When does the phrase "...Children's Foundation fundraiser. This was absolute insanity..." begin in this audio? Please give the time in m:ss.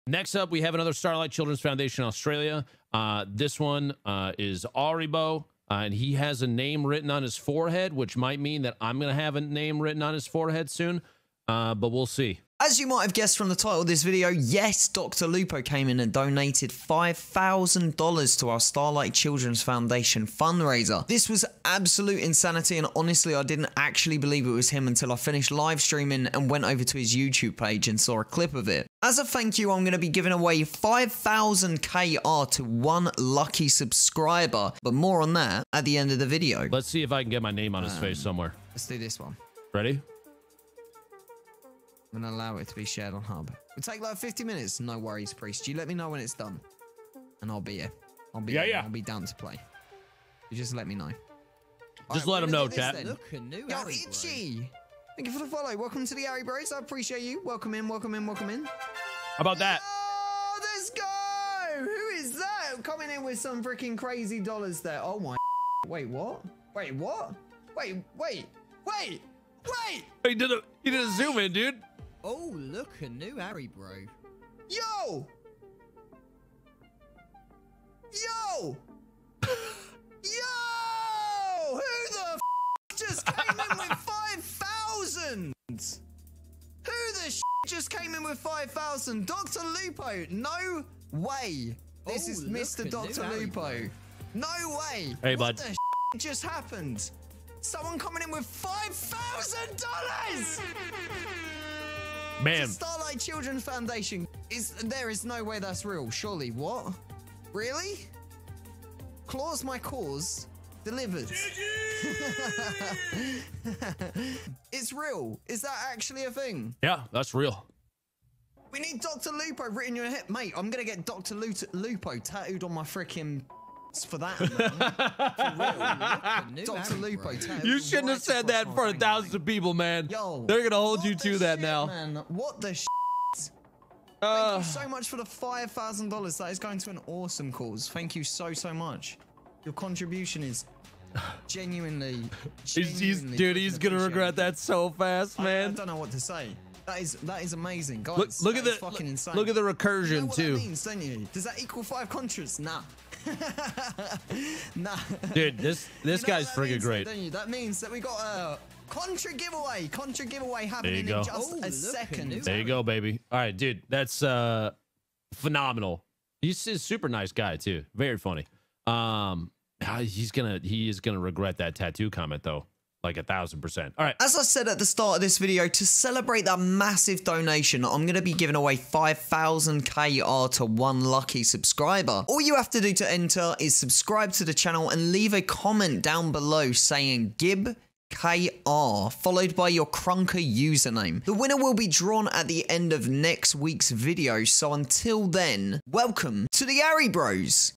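0:19.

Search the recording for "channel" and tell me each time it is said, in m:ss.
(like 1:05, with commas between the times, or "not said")
3:04.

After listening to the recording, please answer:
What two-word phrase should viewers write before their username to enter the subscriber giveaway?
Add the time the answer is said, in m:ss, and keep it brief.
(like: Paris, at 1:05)
Gib KR, at 3:07.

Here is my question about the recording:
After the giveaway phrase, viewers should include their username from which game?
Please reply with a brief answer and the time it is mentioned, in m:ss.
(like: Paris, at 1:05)
Krunker, at 3:09.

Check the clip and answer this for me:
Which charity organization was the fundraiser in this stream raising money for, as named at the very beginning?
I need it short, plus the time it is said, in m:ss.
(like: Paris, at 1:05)
Starlight Children's Foundation Australia, at 0:00.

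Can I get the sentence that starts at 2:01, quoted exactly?
Lupo tattooed on my freaking it's for that amount.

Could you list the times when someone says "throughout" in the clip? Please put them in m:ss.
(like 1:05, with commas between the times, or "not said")
not said.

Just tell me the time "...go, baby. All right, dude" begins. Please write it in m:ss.
2:42.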